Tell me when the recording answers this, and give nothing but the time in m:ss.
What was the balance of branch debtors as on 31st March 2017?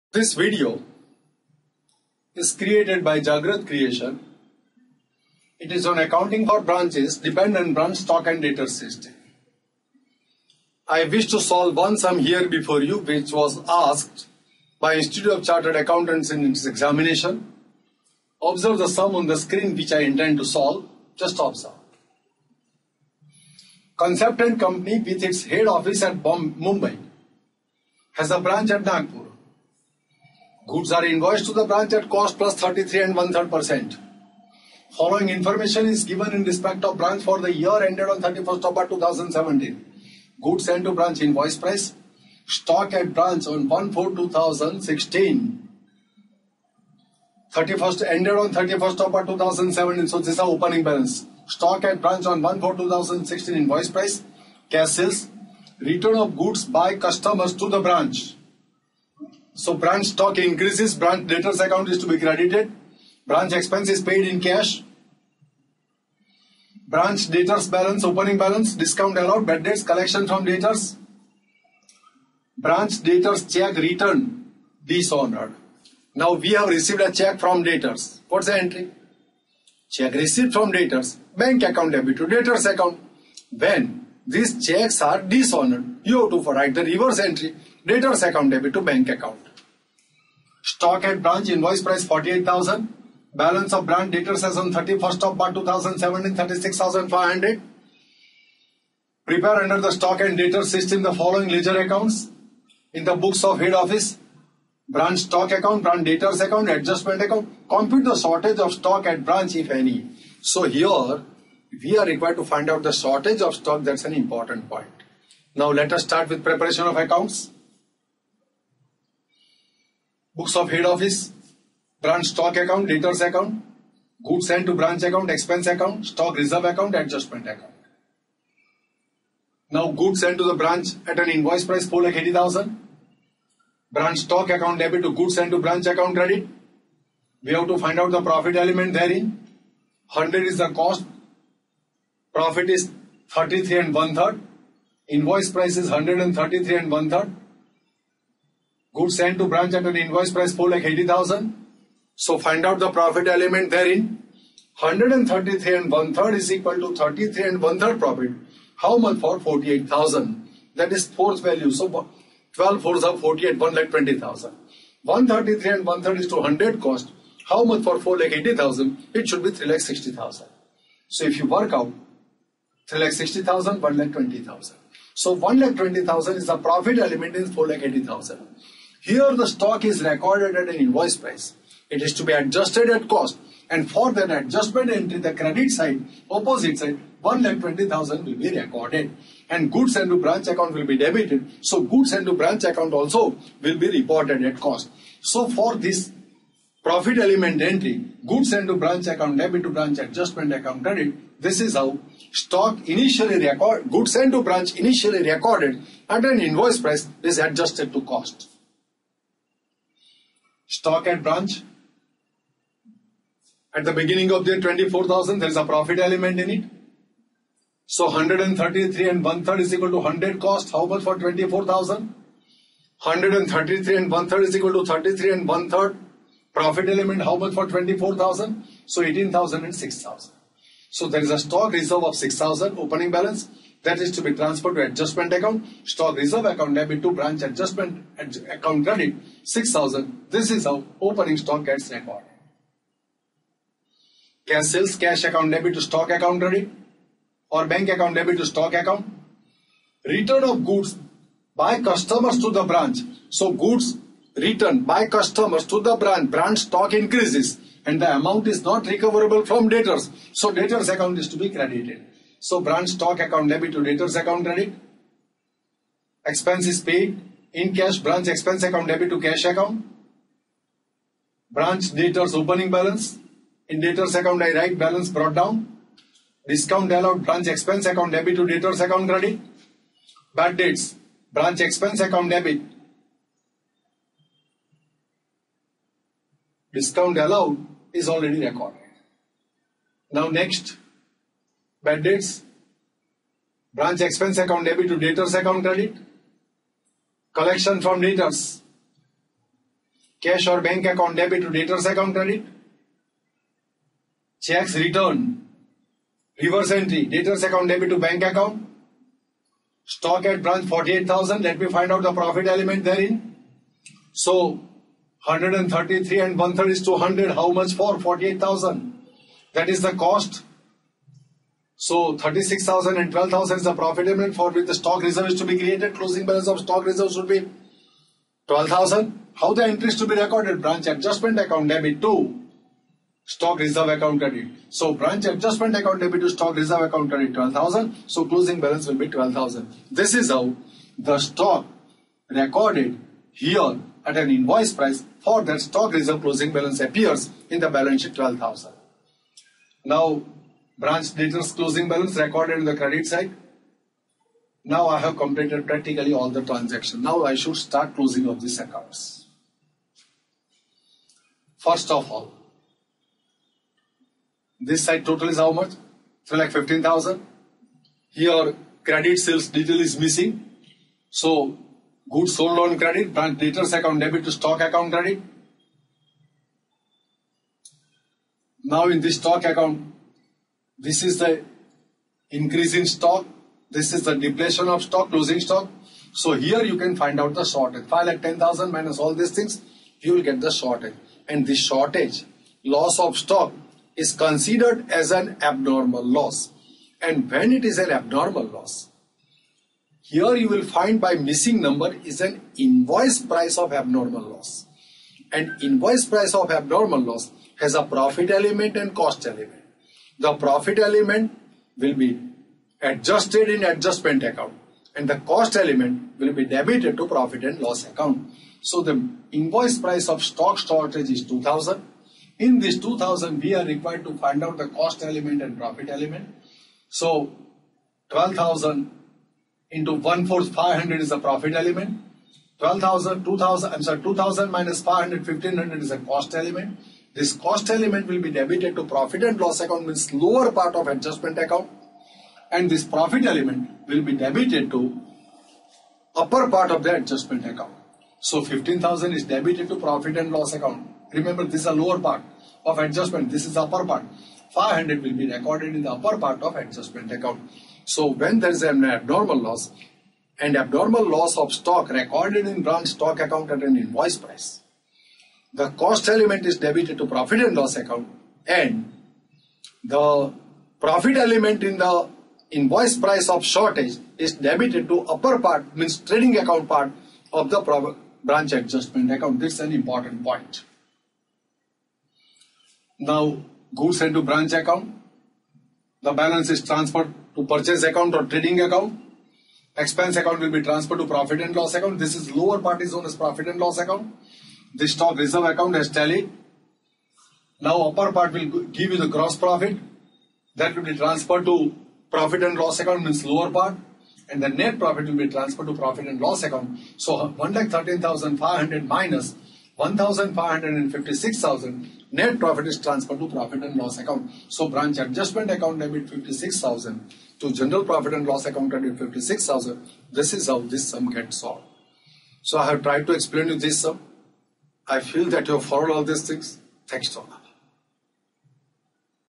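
1:36.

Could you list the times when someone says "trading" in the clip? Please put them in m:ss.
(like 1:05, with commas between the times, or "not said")
7:55, 8:08.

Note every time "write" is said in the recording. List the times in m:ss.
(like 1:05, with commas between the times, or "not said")
1:26, 4:34.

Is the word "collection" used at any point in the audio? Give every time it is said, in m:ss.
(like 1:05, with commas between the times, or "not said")
1:09, 4:57.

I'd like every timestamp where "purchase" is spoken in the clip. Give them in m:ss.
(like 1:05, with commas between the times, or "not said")
8:07.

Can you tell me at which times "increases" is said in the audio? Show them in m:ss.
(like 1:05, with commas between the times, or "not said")
1:00, 4:16, 6:22.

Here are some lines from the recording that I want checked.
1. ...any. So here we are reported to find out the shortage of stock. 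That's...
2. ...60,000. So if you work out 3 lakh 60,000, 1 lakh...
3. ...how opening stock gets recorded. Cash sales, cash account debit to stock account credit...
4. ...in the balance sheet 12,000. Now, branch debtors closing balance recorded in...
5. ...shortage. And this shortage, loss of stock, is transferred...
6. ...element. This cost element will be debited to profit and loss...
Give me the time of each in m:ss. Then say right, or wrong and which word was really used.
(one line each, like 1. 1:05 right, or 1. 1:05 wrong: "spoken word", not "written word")
1. 1:49 wrong: "required", not "reported"
2. 2:49 right
3. 4:00 right
4. 5:47 right
5. 6:30 wrong: "considered", not "transferred"
6. 7:16 right.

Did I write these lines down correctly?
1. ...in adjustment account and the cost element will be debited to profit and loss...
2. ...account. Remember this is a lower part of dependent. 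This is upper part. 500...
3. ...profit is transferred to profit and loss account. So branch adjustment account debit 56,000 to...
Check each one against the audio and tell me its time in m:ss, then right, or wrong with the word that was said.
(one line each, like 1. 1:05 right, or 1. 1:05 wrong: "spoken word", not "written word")
1. 6:53 right
2. 7:30 wrong: "adjustment", not "dependent"
3. 8:32 right.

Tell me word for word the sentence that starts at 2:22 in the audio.
Profit is 33 and one third.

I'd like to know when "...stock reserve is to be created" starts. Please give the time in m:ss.
5:24.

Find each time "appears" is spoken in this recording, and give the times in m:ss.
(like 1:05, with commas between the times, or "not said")
5:46.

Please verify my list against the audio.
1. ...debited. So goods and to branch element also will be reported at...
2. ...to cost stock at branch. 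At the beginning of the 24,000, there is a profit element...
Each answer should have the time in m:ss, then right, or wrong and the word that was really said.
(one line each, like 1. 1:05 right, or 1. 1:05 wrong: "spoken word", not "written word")
1. 3:10 wrong: "account", not "element"
2. 3:27 right.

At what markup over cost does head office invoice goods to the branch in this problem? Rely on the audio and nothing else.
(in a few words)
33 and one third percent.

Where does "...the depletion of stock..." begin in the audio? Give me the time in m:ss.
6:24.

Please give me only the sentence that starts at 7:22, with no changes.
And this profit element will be debited to upper part of the adjustment account.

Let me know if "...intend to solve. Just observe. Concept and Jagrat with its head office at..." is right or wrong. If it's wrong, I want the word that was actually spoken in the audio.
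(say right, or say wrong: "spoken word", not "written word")
wrong: "Company", not "Jagrat".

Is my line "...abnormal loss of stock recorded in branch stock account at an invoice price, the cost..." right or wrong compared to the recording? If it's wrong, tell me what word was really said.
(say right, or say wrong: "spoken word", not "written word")
right.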